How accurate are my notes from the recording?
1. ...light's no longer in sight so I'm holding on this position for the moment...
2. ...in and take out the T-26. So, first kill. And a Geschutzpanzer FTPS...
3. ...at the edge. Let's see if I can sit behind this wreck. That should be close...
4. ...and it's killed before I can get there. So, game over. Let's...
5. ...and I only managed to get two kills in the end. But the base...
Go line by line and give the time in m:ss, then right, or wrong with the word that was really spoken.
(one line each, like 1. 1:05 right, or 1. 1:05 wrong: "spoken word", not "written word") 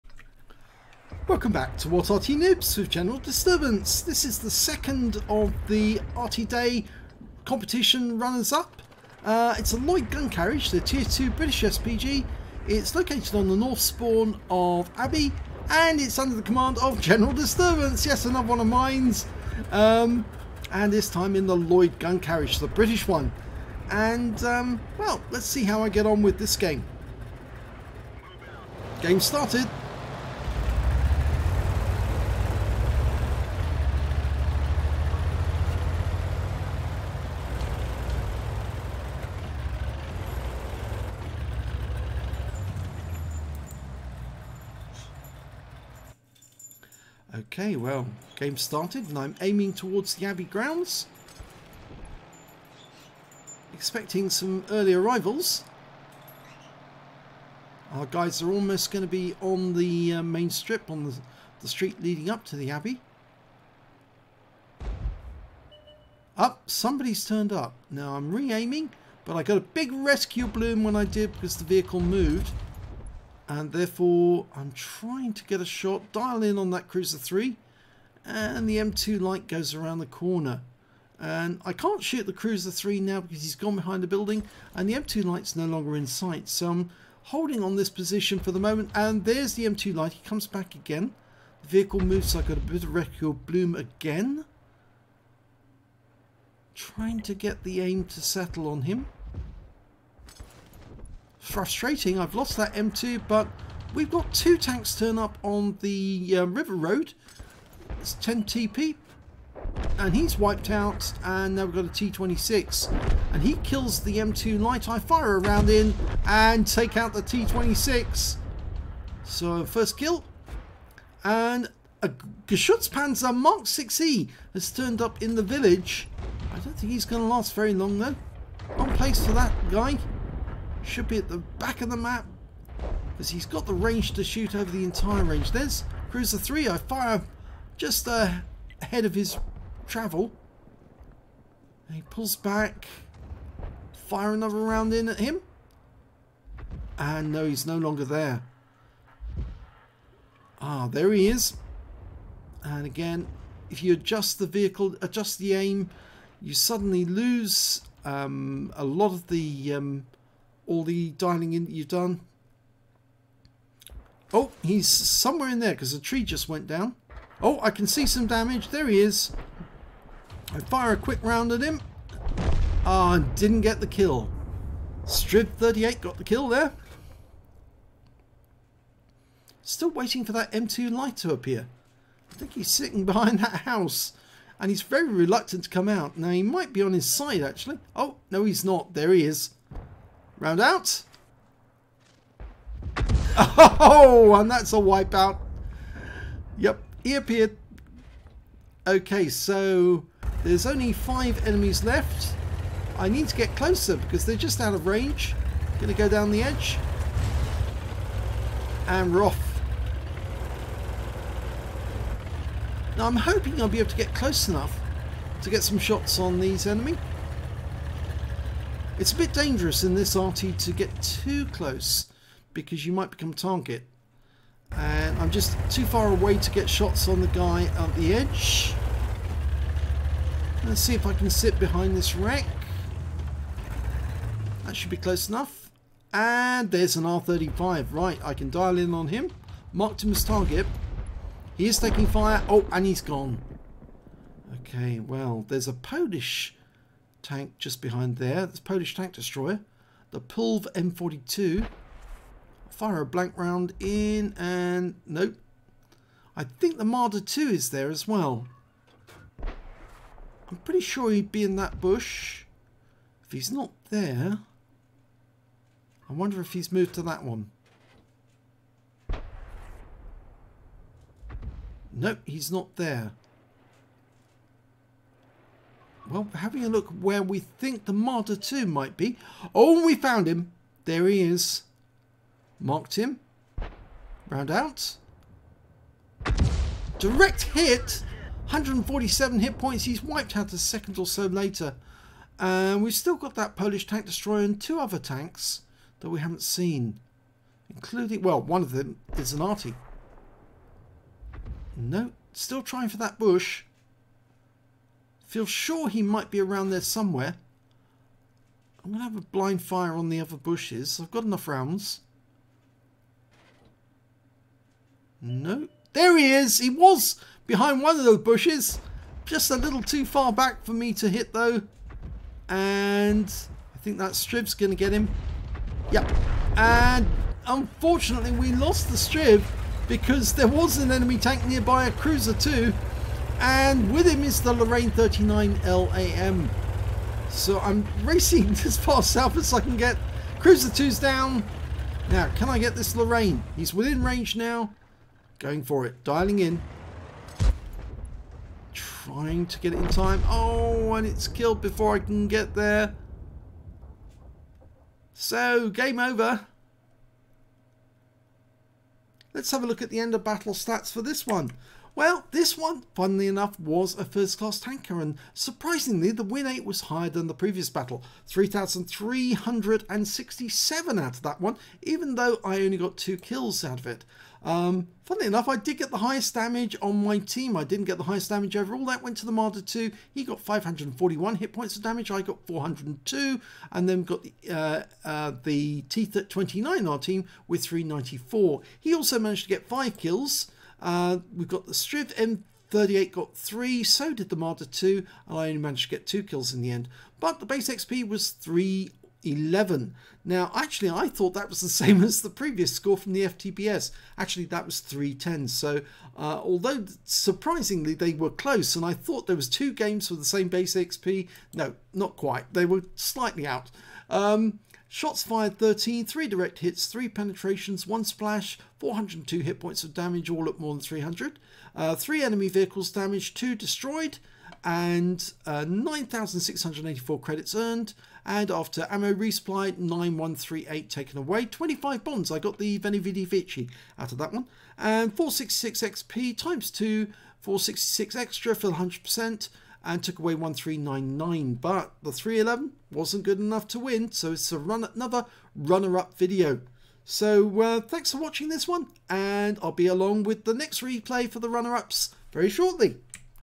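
1. 1:25 right
2. 1:55 wrong: "Mark", not "FTPS"
3. 3:47 right
4. 5:50 right
5. 6:35 right.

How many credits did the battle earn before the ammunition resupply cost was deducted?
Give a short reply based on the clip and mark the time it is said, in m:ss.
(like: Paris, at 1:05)
9,684, at 7:05.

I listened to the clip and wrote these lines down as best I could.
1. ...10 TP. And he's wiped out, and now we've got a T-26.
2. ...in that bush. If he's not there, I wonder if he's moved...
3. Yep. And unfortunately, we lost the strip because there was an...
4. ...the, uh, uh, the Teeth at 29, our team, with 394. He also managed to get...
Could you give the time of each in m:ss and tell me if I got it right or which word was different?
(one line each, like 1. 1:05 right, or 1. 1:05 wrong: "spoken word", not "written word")
1. 1:48 right
2. 4:21 right
3. 5:25 right
4. 6:24 right.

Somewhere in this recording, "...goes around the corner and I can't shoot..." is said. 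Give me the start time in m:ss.
1:19.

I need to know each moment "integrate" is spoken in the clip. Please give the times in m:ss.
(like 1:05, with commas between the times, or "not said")
not said.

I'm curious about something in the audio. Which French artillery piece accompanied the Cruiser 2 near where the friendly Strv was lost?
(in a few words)
Lorraine 39 LAM.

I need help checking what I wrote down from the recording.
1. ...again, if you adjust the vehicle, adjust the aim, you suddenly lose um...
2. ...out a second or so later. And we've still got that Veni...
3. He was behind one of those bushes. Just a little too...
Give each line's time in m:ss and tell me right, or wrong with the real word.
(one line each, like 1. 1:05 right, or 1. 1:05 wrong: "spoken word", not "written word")
1. 2:32 right
2. 4:50 wrong: "Polish", not "Veni"
3. 5:16 right.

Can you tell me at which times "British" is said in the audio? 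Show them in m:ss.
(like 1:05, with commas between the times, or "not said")
0:11, 0:22.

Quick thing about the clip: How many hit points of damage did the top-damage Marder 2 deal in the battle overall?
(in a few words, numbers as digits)
541.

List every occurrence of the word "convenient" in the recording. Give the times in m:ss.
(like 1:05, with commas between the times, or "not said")
not said.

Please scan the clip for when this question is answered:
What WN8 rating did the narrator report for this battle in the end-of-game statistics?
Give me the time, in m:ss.
6:08.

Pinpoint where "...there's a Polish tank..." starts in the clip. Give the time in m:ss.
4:05.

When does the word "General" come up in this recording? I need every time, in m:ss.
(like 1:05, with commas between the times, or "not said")
0:02, 0:16.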